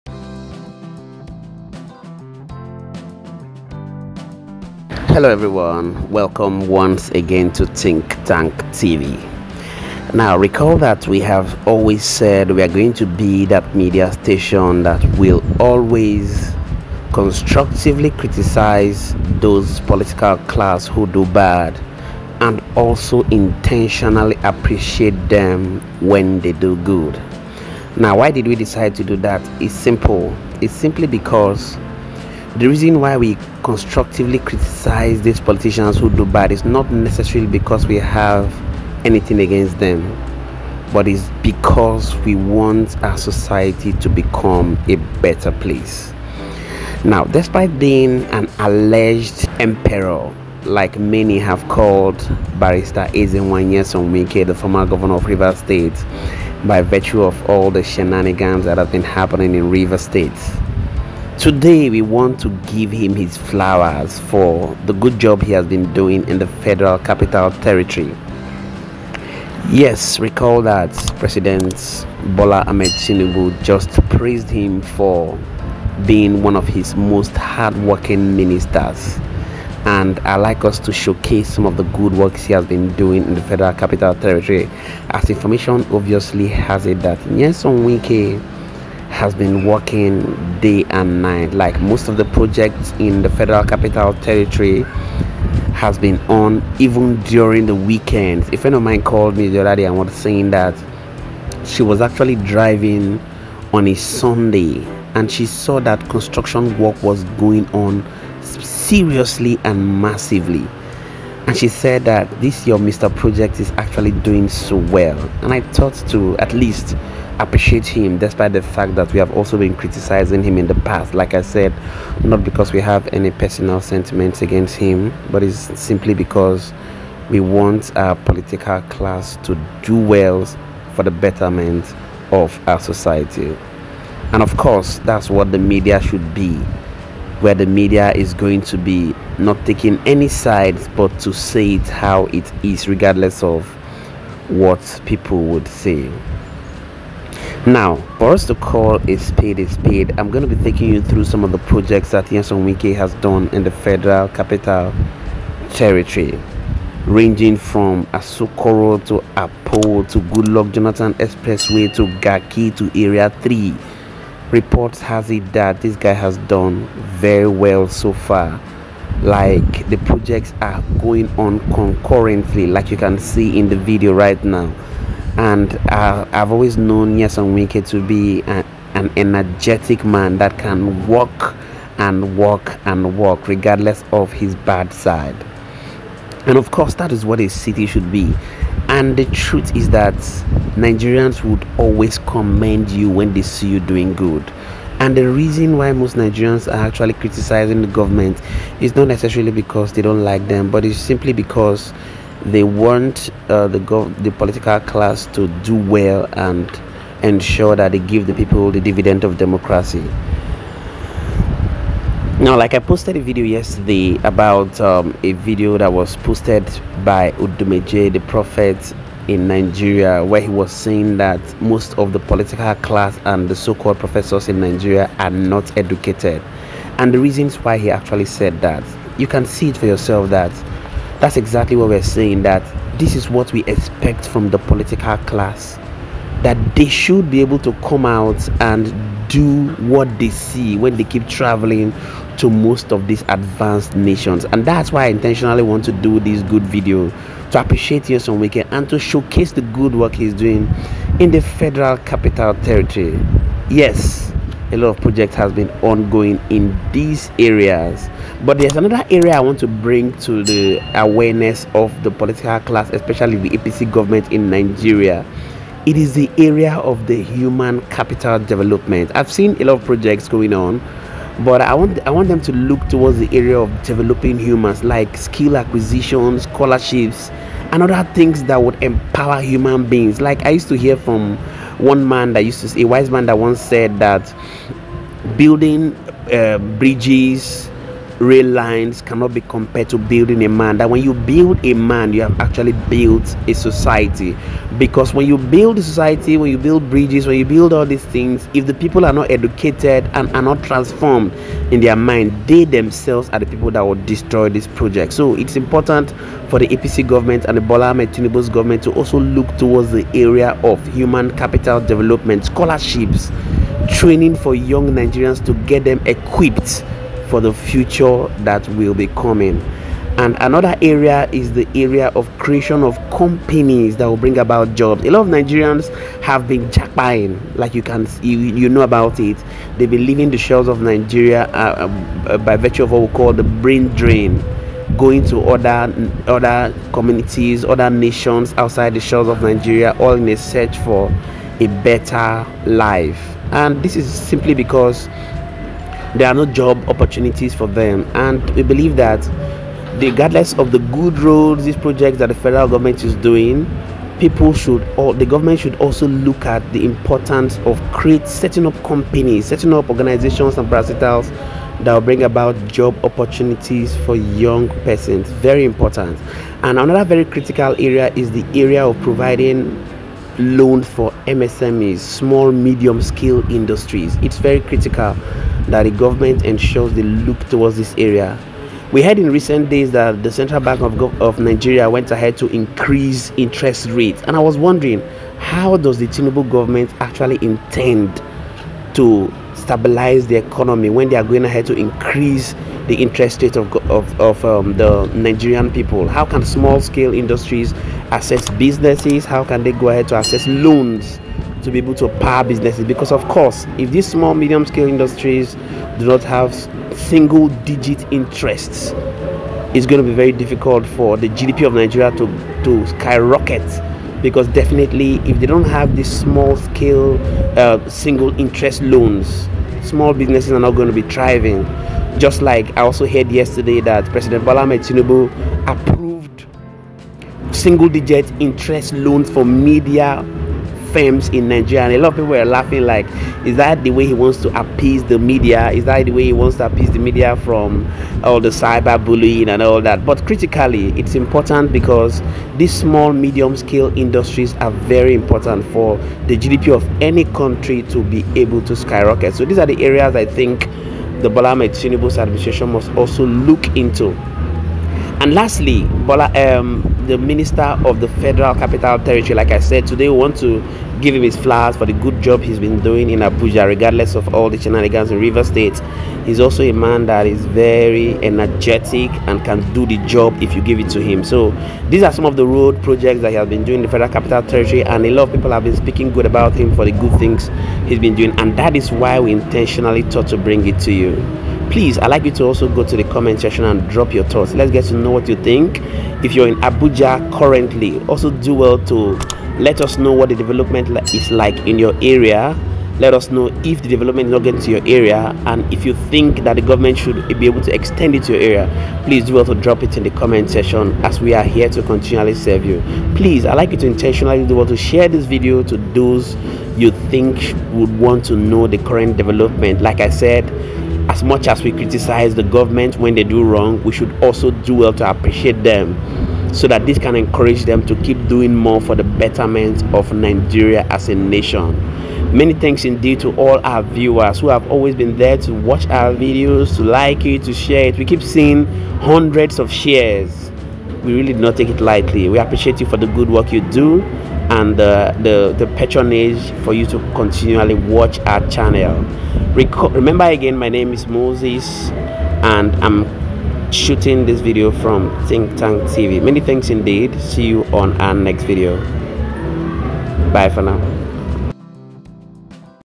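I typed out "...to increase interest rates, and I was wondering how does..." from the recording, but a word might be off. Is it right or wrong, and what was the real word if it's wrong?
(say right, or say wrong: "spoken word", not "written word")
right.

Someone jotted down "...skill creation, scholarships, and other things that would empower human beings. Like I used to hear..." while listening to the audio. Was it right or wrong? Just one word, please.
wrong.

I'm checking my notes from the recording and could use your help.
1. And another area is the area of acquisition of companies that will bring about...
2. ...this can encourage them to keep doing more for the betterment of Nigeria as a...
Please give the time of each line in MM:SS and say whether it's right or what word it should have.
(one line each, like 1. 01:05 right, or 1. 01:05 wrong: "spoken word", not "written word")
1. 05:20 wrong: "creation", not "acquisition"
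2. 08:36 right.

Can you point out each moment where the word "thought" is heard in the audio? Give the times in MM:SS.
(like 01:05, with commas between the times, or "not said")
01:55, 08:00, 08:04.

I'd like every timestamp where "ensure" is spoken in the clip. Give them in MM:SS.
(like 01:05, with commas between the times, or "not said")
03:27, 06:16.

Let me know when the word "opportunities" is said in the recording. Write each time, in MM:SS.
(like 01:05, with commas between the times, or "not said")
05:46, 06:03.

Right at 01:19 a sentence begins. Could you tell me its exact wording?
And I like us to showcase some of the good works he has been doing in the Federal Capital Territory.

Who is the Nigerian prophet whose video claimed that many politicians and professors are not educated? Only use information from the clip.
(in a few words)
Odumeje.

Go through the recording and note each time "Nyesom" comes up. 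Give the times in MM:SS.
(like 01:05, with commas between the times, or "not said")
00:53, 01:27, 02:32, 02:57, 04:08.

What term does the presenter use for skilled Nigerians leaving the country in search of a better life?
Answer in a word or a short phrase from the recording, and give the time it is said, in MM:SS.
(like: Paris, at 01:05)
brain drain, at 05:33.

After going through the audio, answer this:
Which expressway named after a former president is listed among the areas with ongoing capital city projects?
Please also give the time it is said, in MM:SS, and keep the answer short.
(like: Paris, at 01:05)
Goodluck Jonathan Expressway, at 02:40.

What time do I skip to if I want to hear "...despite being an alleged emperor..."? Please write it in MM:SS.
00:47.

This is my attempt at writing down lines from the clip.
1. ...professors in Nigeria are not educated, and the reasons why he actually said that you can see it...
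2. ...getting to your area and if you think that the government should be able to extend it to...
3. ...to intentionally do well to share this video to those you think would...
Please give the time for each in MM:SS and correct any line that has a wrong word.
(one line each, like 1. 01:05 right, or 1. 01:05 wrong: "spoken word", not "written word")
1. 03:43 right
2. 08:14 right
3. 08:23 right.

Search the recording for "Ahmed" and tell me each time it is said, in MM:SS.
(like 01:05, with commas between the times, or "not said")
01:12, 05:07.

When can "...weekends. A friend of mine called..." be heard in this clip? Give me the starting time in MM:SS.
01:37.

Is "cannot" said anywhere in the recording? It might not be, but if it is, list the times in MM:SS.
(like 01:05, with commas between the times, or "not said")
04:49.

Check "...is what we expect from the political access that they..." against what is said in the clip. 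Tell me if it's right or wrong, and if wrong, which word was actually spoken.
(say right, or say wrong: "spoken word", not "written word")
wrong: "class", not "access".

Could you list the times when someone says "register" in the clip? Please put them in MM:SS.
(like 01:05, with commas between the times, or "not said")
not said.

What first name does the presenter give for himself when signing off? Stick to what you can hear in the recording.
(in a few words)
Moses.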